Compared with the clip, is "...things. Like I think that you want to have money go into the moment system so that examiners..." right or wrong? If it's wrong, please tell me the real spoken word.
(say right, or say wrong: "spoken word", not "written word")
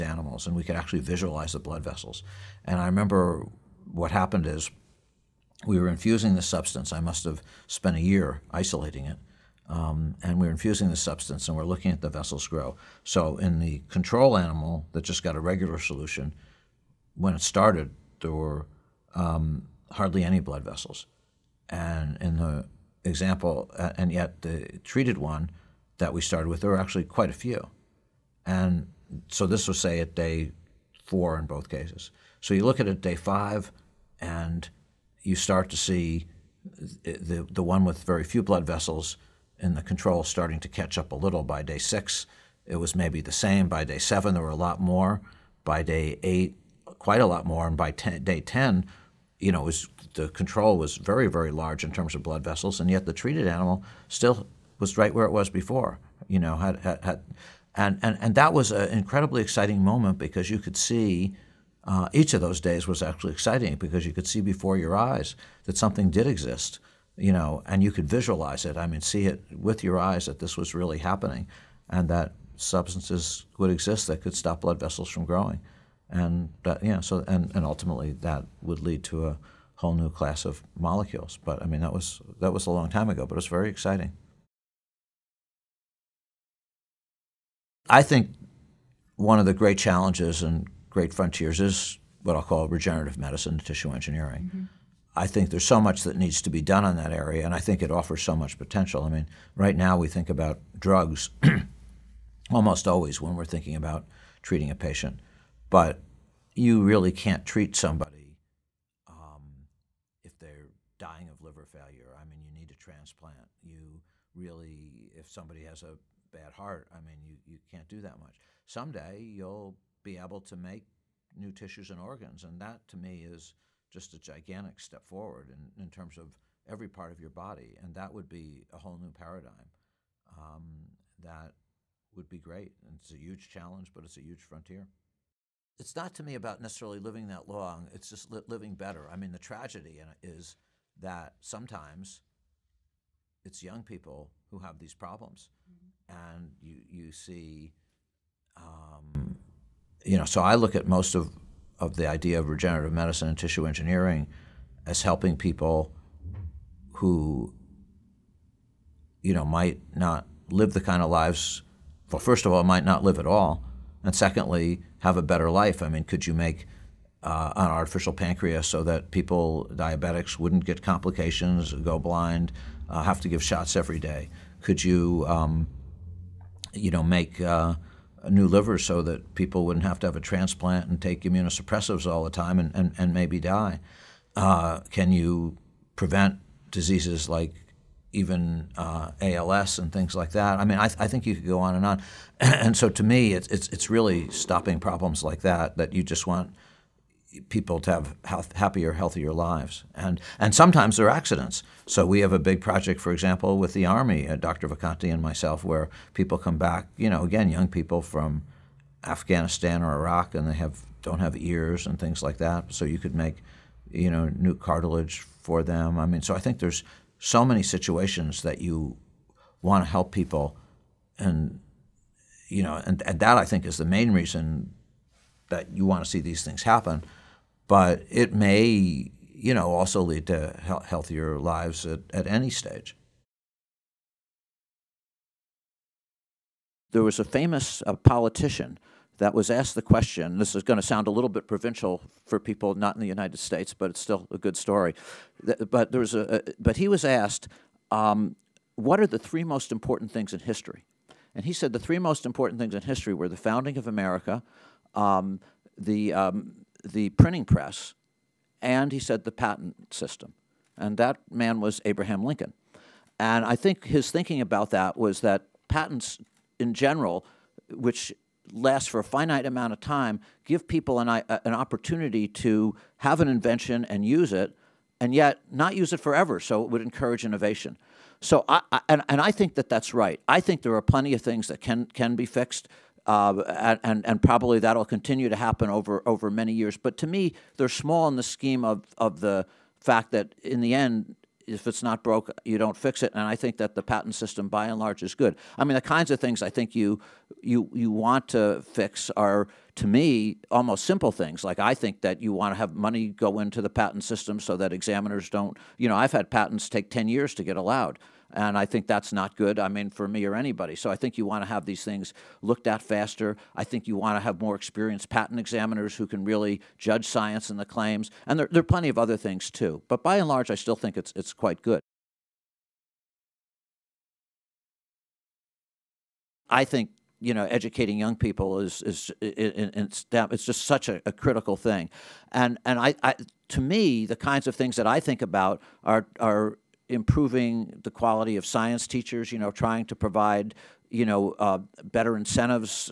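wrong: "patent", not "moment".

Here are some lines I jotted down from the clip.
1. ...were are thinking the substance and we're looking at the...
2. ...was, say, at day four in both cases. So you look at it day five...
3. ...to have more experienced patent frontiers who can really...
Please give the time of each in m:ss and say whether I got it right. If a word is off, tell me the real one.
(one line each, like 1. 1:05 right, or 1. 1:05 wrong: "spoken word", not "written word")
1. 0:10 wrong: "infusing", not "thinking"
2. 0:29 right
3. 5:14 wrong: "examiners", not "frontiers".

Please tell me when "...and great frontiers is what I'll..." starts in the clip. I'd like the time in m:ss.
1:30.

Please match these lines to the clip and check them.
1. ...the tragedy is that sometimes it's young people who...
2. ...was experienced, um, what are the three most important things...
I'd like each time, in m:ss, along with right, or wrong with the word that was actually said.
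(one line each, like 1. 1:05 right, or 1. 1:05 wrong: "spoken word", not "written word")
1. 2:19 right
2. 4:06 wrong: "asked", not "experienced".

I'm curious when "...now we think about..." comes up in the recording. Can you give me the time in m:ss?
1:39.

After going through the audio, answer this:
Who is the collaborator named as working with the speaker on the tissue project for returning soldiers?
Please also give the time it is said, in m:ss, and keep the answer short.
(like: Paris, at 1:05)
Dr. Vacanti, at 3:24.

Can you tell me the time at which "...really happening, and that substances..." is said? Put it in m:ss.
1:10.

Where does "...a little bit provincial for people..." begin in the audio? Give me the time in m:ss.
4:01.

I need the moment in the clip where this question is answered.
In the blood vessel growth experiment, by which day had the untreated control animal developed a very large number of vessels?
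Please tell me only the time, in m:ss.
0:48.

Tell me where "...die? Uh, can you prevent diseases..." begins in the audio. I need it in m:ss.
3:03.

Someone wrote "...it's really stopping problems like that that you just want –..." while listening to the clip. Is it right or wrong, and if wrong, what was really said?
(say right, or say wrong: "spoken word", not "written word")
right.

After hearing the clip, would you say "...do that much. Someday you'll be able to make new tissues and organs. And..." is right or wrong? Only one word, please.
right.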